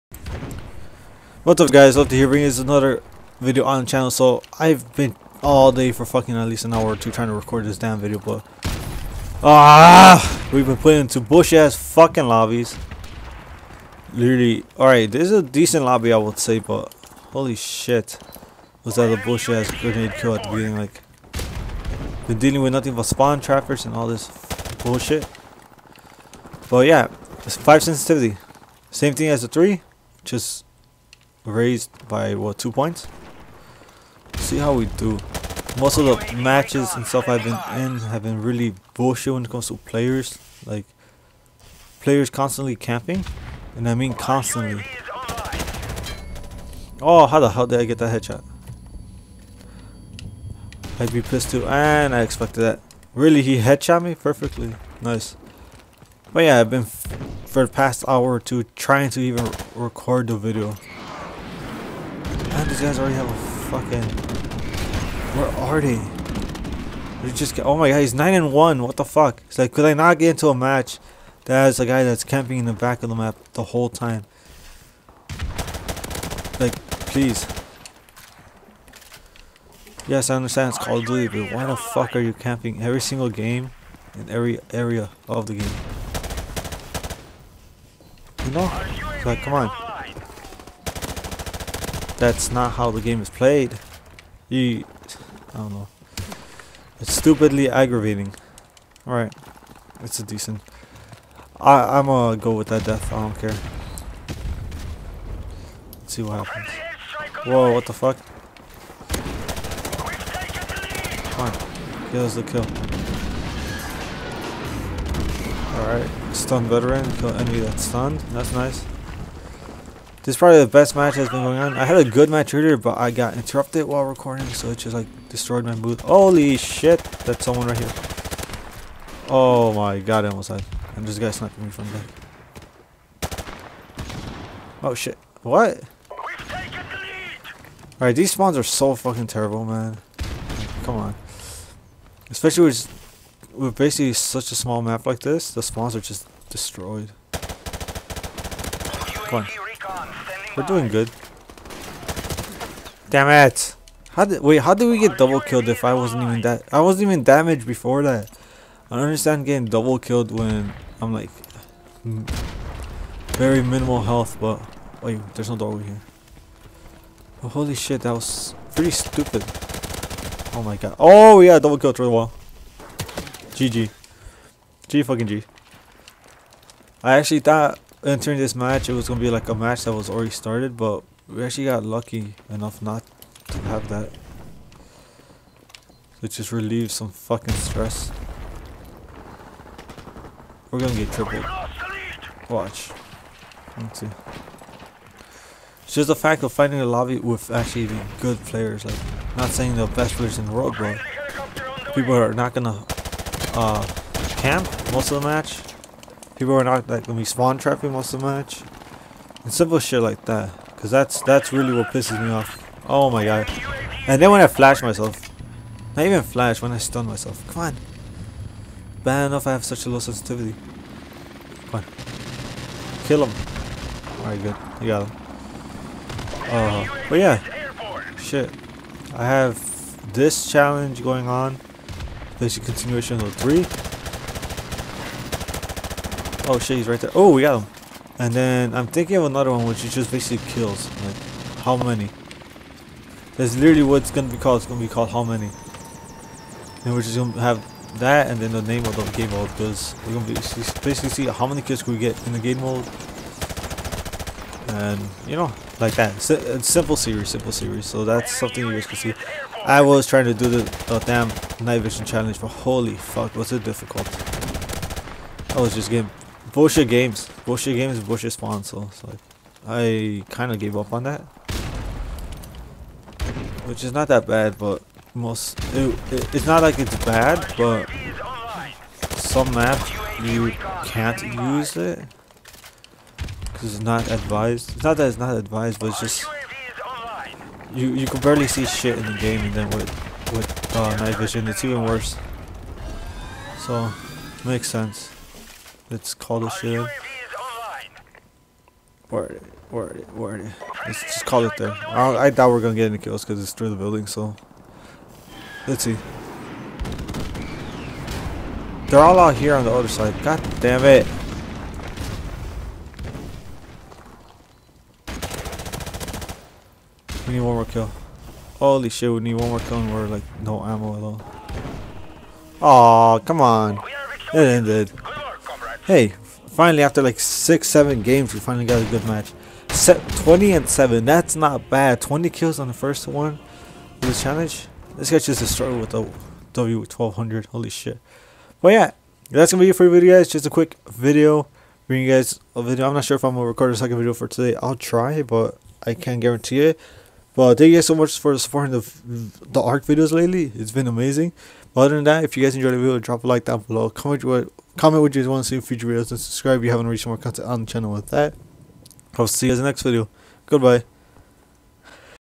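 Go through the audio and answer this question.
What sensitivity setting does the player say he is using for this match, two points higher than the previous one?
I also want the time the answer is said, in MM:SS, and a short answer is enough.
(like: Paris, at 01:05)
5, at 00:27.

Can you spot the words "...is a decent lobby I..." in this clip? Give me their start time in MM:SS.
00:15.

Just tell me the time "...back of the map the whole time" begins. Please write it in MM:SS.
01:12.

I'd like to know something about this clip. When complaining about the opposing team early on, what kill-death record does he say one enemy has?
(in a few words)
9 and 1.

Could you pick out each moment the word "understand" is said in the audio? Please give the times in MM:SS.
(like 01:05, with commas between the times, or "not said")
01:20, 02:39.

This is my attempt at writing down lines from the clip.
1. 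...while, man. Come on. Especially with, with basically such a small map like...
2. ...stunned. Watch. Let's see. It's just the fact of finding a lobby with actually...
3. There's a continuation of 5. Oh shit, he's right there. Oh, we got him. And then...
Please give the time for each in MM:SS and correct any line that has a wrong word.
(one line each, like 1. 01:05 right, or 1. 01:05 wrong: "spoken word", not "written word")
1. 02:19 wrong: "terrible", not "while"
2. 03:11 wrong: "tripled", not "stunned"
3. 03:52 wrong: "3", not "5".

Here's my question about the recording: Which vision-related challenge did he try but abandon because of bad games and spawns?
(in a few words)
Night vision challenge.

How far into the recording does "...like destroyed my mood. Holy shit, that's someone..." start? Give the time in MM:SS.
02:04.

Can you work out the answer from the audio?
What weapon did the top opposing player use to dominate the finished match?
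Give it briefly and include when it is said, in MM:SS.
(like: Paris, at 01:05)
W1200, at 05:36.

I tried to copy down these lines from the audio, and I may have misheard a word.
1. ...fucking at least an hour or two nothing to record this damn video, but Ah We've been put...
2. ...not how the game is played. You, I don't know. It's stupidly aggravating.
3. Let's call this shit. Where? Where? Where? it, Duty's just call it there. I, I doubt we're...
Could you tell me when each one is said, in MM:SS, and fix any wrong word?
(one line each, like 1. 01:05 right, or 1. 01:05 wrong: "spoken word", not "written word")
1. 00:06 wrong: "trying", not "nothing"
2. 01:32 right
3. 04:55 wrong: "Let", not "Duty".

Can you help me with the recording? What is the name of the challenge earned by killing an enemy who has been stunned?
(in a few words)
Stun veteran.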